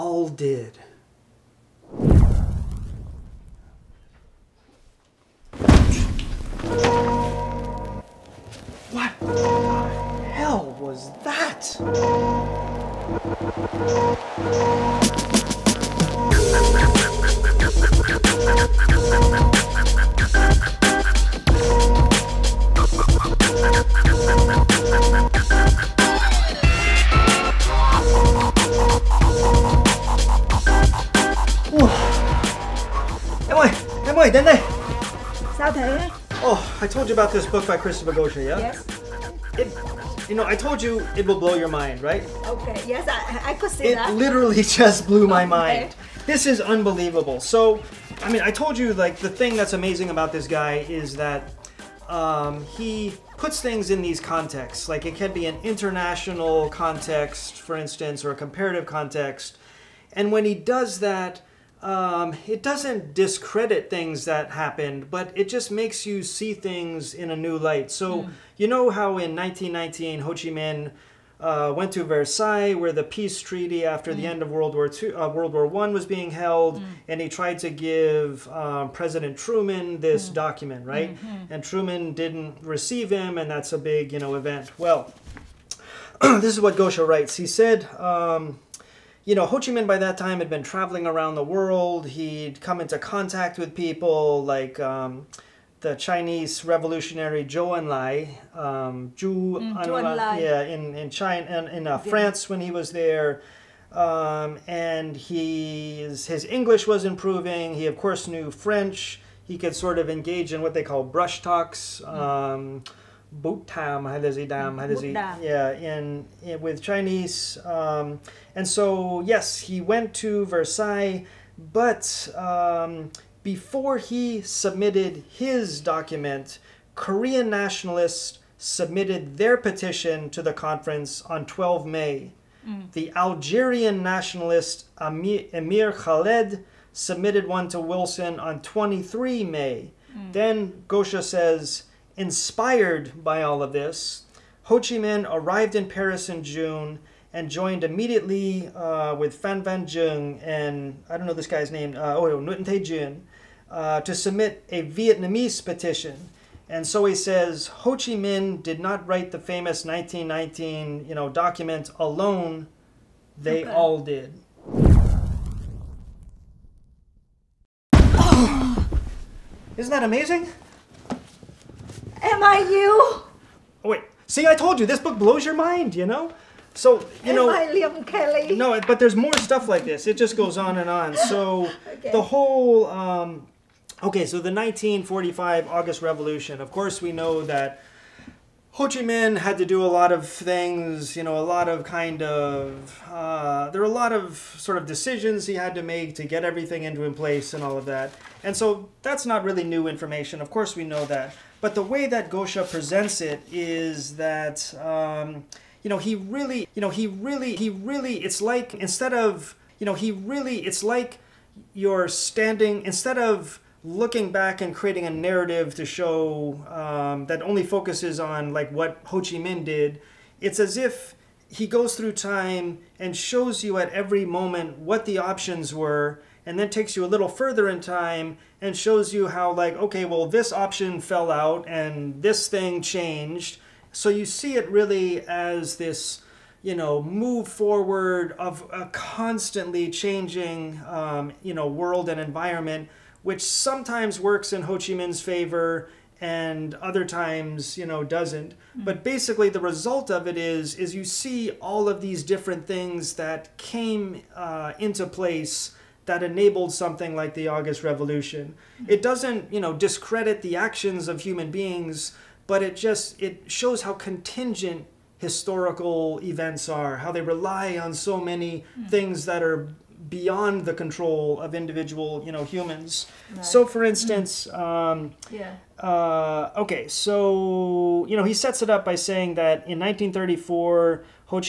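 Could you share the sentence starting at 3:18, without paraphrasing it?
And so that's not really new information.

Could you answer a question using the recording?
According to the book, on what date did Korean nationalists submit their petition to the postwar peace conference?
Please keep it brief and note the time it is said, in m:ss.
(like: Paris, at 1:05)
12 May, at 2:11.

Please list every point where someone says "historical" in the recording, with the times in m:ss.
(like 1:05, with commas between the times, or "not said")
4:25.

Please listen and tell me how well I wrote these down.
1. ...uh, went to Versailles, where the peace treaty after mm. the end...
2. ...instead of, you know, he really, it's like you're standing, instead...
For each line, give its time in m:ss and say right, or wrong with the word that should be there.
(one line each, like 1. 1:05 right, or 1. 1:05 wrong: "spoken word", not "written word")
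1. 1:11 right
2. 3:28 right.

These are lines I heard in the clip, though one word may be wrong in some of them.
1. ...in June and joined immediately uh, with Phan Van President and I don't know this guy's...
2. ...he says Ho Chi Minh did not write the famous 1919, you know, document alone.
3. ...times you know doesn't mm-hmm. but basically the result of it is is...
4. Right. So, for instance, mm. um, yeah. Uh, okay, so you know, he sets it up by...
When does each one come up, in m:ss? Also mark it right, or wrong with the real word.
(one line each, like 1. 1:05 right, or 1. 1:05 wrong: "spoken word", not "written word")
1. 2:26 wrong: "Truong", not "President"
2. 2:37 right
3. 4:07 right
4. 4:33 right.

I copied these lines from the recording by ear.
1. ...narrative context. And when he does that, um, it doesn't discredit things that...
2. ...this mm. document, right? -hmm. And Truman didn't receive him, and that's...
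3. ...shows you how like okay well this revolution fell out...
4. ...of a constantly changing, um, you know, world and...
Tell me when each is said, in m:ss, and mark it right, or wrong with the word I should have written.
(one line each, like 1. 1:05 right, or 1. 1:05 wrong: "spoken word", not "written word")
1. 0:58 wrong: "comparative", not "narrative"
2. 1:20 right
3. 3:48 wrong: "option", not "revolution"
4. 3:58 right.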